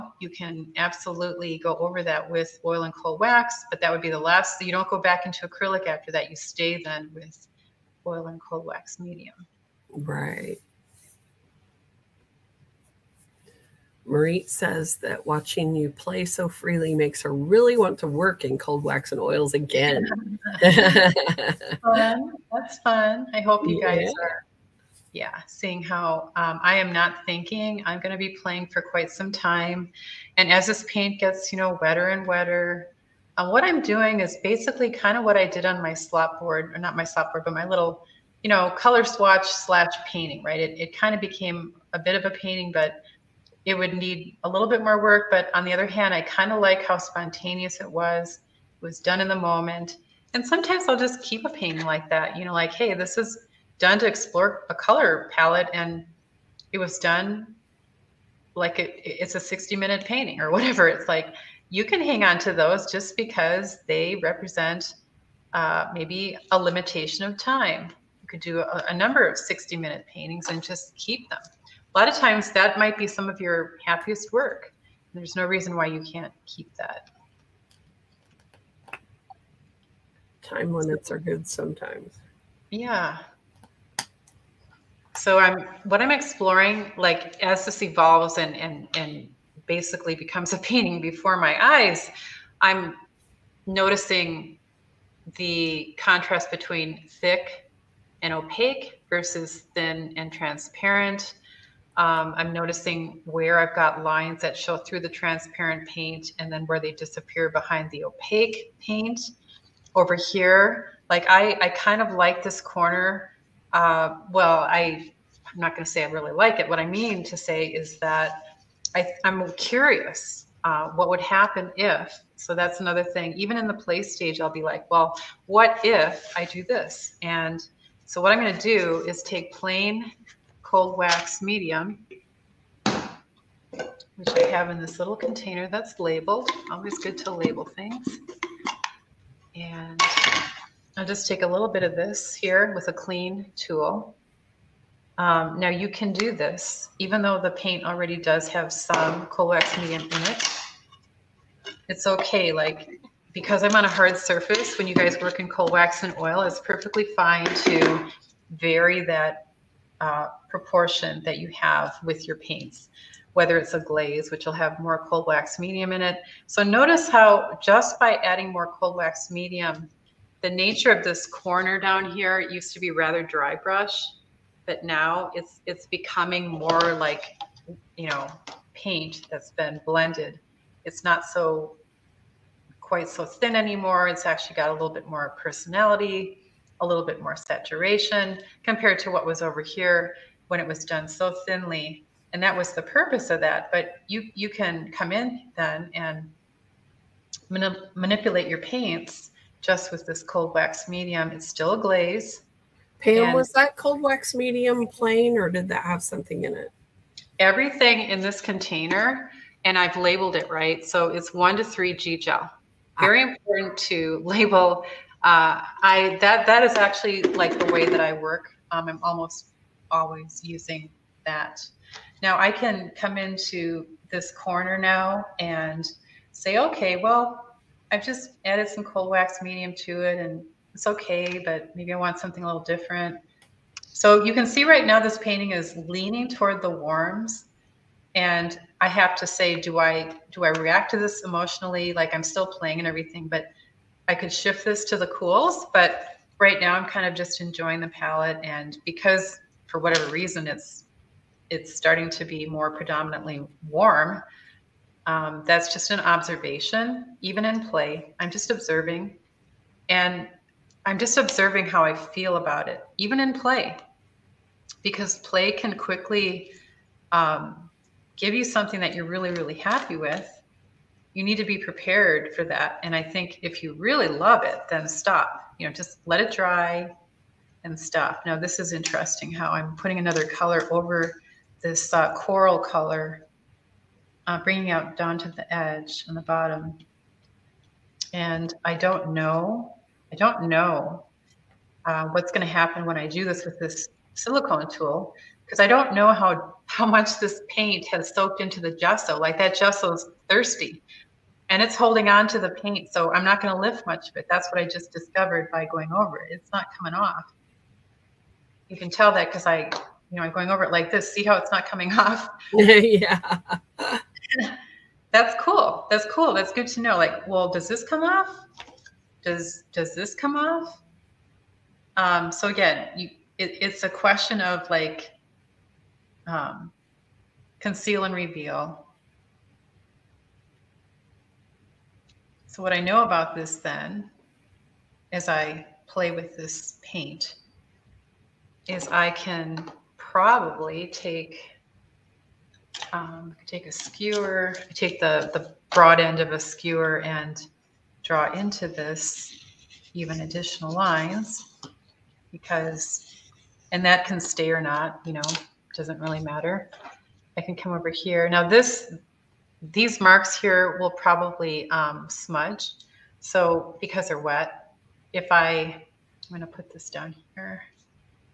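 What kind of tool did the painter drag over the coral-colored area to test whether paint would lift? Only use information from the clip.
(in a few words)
silicone tool.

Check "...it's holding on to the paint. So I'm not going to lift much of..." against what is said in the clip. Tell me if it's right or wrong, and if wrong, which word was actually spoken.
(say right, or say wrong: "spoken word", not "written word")
right.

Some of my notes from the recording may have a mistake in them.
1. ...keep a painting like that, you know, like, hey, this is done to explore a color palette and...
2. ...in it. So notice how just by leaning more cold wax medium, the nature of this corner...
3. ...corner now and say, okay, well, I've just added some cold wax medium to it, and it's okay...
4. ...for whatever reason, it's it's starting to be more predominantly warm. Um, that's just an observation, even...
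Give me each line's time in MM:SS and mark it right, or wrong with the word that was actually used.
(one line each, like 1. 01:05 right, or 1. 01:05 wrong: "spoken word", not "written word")
1. 00:51 right
2. 02:45 wrong: "adding", not "leaning"
3. 03:44 right
4. 04:09 right.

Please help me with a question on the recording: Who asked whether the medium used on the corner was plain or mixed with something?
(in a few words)
Pam.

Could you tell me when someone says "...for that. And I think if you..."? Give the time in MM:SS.
04:32.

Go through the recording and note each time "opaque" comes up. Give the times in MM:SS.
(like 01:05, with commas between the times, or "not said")
01:38, 01:48.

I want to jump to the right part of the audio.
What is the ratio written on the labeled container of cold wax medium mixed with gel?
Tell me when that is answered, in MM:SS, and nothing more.
03:31.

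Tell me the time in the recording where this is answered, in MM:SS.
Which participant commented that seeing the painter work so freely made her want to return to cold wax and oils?
00:14.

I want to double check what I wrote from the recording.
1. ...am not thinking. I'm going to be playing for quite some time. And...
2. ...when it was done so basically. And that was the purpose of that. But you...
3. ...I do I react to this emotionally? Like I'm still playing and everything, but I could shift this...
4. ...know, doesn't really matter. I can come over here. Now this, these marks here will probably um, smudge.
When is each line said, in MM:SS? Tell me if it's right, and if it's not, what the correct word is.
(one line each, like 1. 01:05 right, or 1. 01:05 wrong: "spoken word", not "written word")
1. 00:26 right
2. 03:10 wrong: "thinly", not "basically"
3. 03:59 right
4. 05:55 right.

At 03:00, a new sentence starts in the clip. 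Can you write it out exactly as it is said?
It's not so quite so thin anymore.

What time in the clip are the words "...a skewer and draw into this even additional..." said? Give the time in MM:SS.
05:46.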